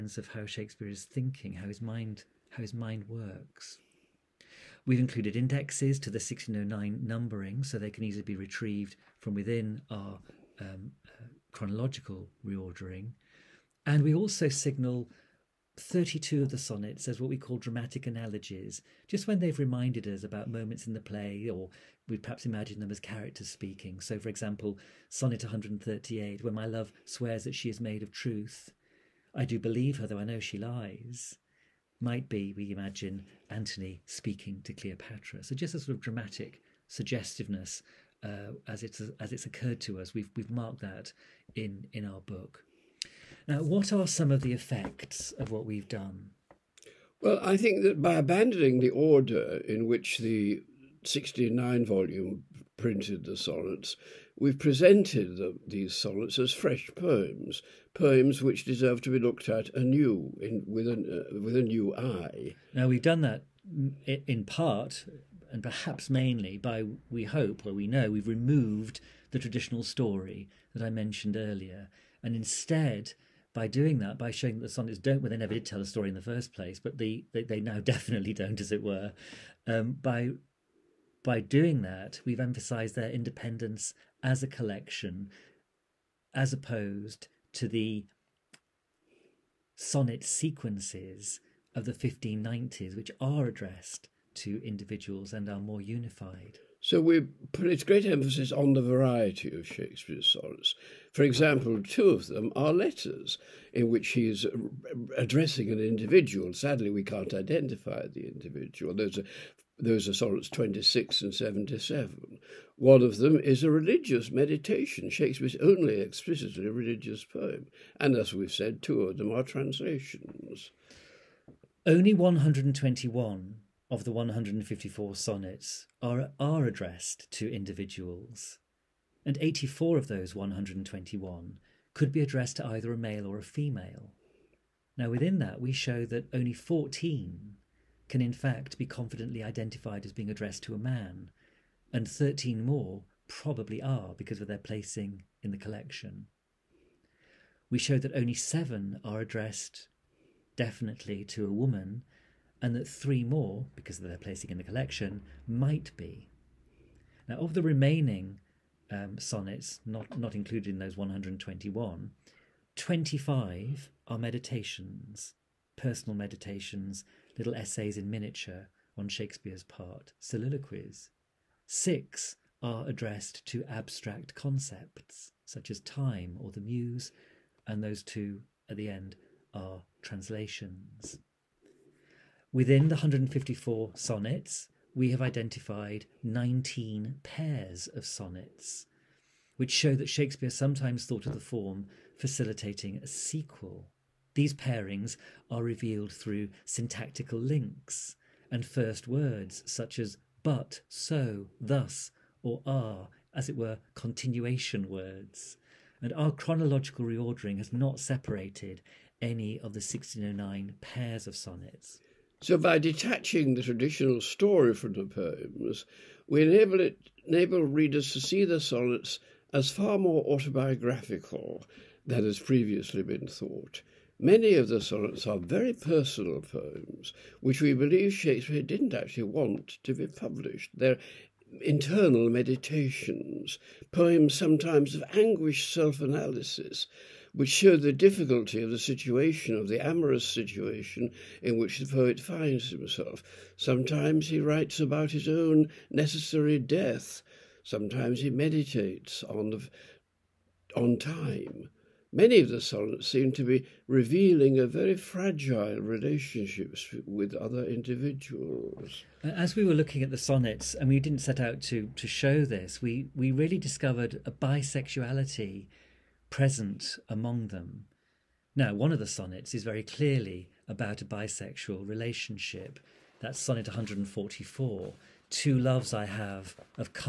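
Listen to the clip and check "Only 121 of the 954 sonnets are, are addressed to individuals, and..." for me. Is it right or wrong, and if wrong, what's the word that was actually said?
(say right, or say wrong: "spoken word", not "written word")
wrong: "154", not "954".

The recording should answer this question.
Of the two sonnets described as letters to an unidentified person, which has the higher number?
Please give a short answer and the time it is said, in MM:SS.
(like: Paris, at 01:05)
77, at 01:51.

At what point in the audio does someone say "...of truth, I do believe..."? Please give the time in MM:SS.
00:28.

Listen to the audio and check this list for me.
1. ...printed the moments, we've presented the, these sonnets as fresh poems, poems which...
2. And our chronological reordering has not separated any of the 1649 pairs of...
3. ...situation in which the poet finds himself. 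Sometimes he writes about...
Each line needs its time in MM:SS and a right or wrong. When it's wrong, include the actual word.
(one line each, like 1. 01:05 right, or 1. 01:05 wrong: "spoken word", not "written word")
1. 00:52 wrong: "sonnets", not "moments"
2. 03:26 wrong: "1609", not "1649"
3. 04:00 right.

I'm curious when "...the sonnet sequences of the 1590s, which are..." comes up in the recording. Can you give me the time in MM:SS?
01:27.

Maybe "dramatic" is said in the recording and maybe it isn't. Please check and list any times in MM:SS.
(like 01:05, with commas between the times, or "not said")
00:17, 00:35.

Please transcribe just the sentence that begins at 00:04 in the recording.
We've included indexes to the 1609 numbering so they can easily be retrieved from within our um, uh, chronological reordering.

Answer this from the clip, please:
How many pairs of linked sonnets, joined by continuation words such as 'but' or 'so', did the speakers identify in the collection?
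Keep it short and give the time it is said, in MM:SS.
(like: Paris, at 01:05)
19, at 03:06.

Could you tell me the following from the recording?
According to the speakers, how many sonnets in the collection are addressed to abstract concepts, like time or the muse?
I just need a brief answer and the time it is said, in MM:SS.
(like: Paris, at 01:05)
6, at 02:51.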